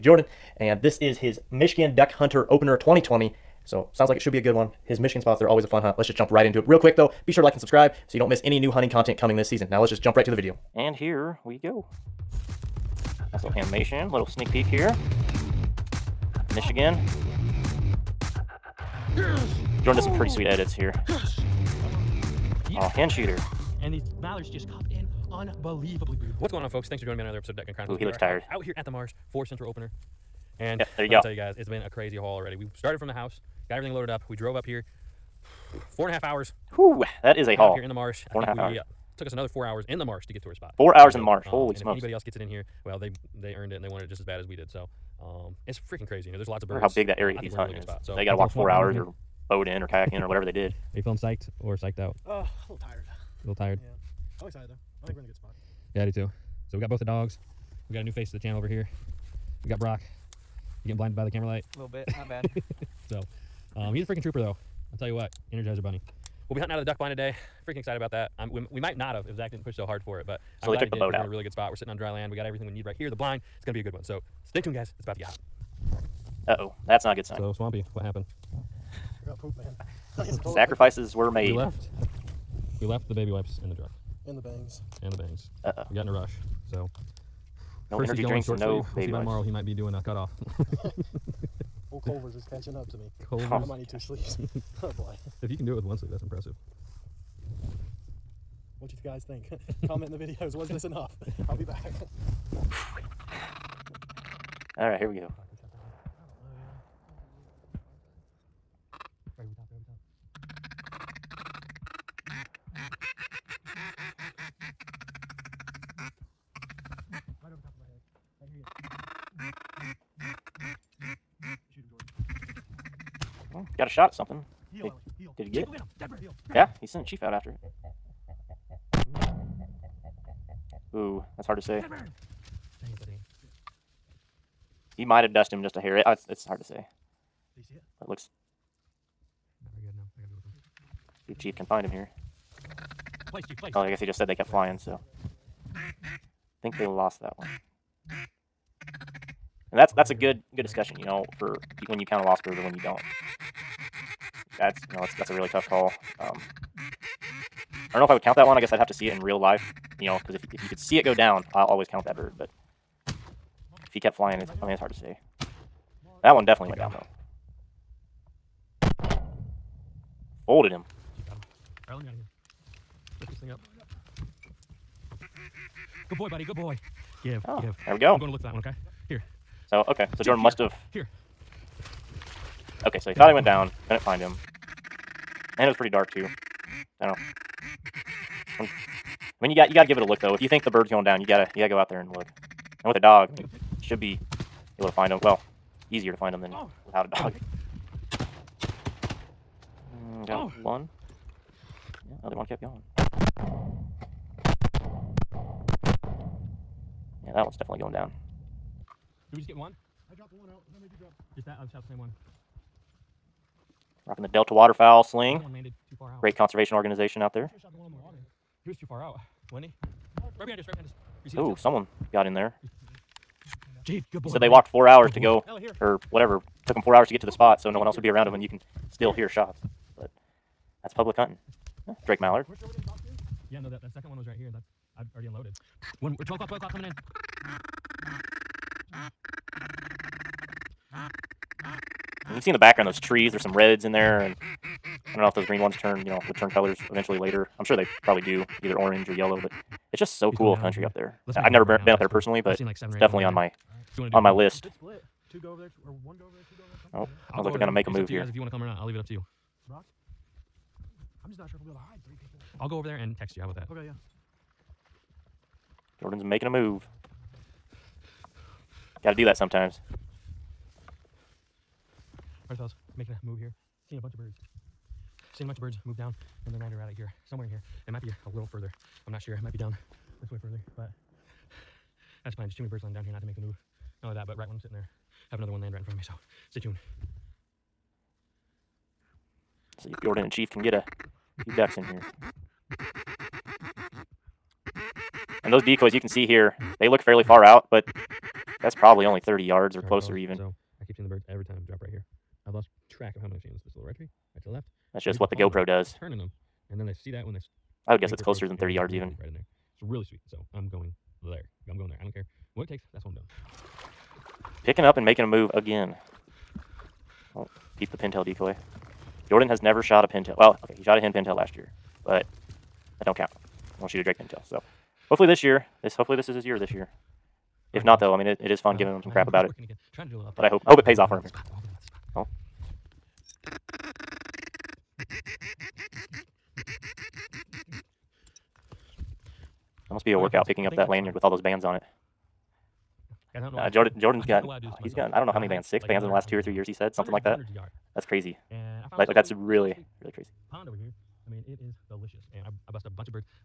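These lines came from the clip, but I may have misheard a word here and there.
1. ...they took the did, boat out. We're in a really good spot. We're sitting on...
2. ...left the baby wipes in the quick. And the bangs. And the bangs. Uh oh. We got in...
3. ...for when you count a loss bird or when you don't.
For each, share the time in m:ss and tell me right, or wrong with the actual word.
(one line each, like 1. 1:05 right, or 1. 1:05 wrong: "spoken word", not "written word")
1. 1:10 right
2. 1:22 wrong: "truck", not "quick"
3. 2:31 right.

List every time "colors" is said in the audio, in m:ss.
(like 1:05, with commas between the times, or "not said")
4:06.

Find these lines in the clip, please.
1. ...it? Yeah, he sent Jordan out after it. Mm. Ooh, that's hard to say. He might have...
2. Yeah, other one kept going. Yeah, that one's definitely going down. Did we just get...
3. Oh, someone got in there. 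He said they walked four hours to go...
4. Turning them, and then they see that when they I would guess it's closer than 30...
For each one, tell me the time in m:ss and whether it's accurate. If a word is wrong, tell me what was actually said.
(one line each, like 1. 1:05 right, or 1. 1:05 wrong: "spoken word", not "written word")
1. 2:05 wrong: "Chief", not "Jordan"
2. 3:22 right
3. 3:41 right
4. 5:06 right.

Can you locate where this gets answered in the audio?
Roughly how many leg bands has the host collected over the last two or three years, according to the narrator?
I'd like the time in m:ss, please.
5:45.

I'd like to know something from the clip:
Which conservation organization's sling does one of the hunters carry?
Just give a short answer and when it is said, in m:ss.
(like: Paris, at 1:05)
Delta Waterfowl, at 3:34.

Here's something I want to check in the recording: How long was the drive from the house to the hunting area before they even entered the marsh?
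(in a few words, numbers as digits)
4.5 hours.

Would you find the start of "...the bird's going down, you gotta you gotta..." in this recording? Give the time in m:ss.
3:10.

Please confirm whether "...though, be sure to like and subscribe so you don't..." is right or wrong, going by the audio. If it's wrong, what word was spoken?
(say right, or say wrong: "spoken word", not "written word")
right.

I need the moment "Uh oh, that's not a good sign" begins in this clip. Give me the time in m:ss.
1:16.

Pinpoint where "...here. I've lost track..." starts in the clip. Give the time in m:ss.
5:01.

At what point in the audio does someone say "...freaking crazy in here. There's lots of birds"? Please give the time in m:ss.
0:45.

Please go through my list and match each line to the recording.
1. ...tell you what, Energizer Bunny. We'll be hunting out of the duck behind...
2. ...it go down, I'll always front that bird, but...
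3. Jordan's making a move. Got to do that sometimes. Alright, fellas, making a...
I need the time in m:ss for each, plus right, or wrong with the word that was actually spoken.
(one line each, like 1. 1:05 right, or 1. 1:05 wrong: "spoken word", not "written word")
1. 1:04 wrong: "blind", not "behind"
2. 2:40 wrong: "count", not "front"
3. 4:25 right.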